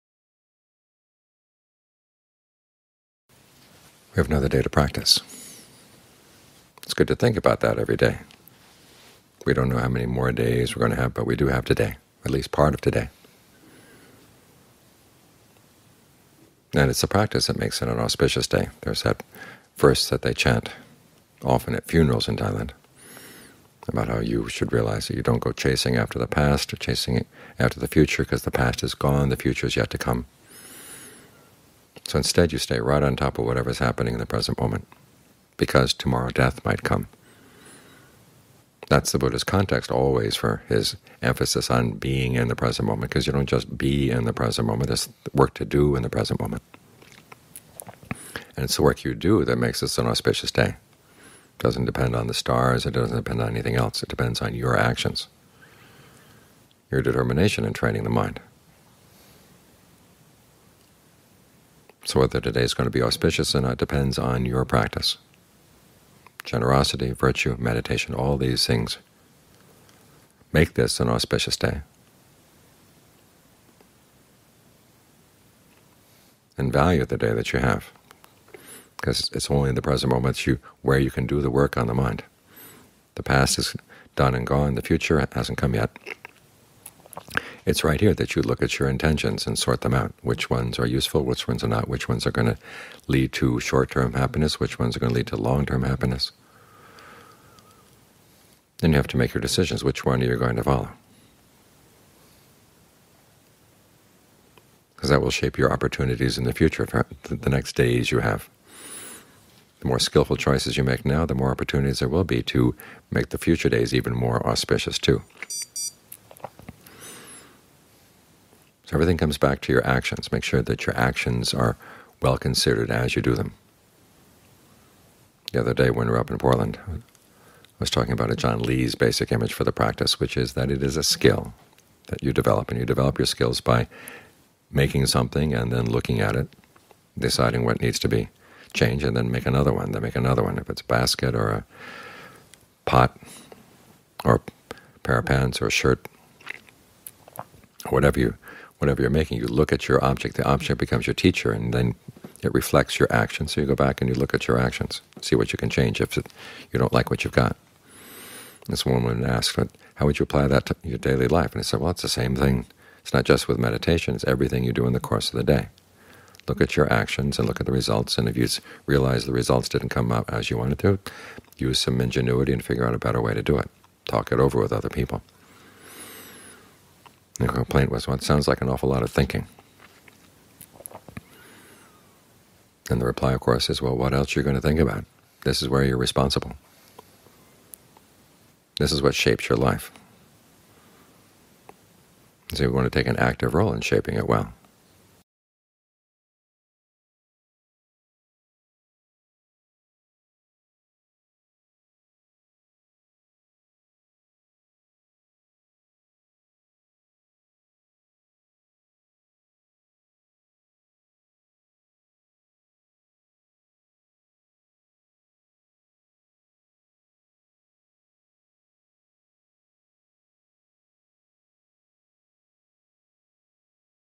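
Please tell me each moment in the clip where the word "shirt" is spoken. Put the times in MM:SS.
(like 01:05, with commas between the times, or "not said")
02:25.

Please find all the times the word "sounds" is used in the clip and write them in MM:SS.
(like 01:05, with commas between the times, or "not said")
02:58.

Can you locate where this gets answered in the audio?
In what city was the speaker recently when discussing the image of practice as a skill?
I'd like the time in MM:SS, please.
02:06.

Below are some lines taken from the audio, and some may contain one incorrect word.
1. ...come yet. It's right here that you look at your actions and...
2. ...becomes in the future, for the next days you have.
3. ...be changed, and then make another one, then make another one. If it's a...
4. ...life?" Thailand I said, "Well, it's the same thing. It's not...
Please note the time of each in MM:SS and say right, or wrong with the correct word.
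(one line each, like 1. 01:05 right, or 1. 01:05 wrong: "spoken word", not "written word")
1. 01:25 wrong: "intentions", not "actions"
2. 01:45 wrong: "opportunities", not "becomes"
3. 02:18 right
4. 02:41 wrong: "And", not "Thailand".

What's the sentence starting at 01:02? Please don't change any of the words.
So whether today is going to be auspicious or not depends on your practice.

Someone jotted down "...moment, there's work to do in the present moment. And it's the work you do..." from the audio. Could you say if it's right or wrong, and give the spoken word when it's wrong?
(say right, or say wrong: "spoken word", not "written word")
right.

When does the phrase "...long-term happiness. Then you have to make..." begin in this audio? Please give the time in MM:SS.
01:35.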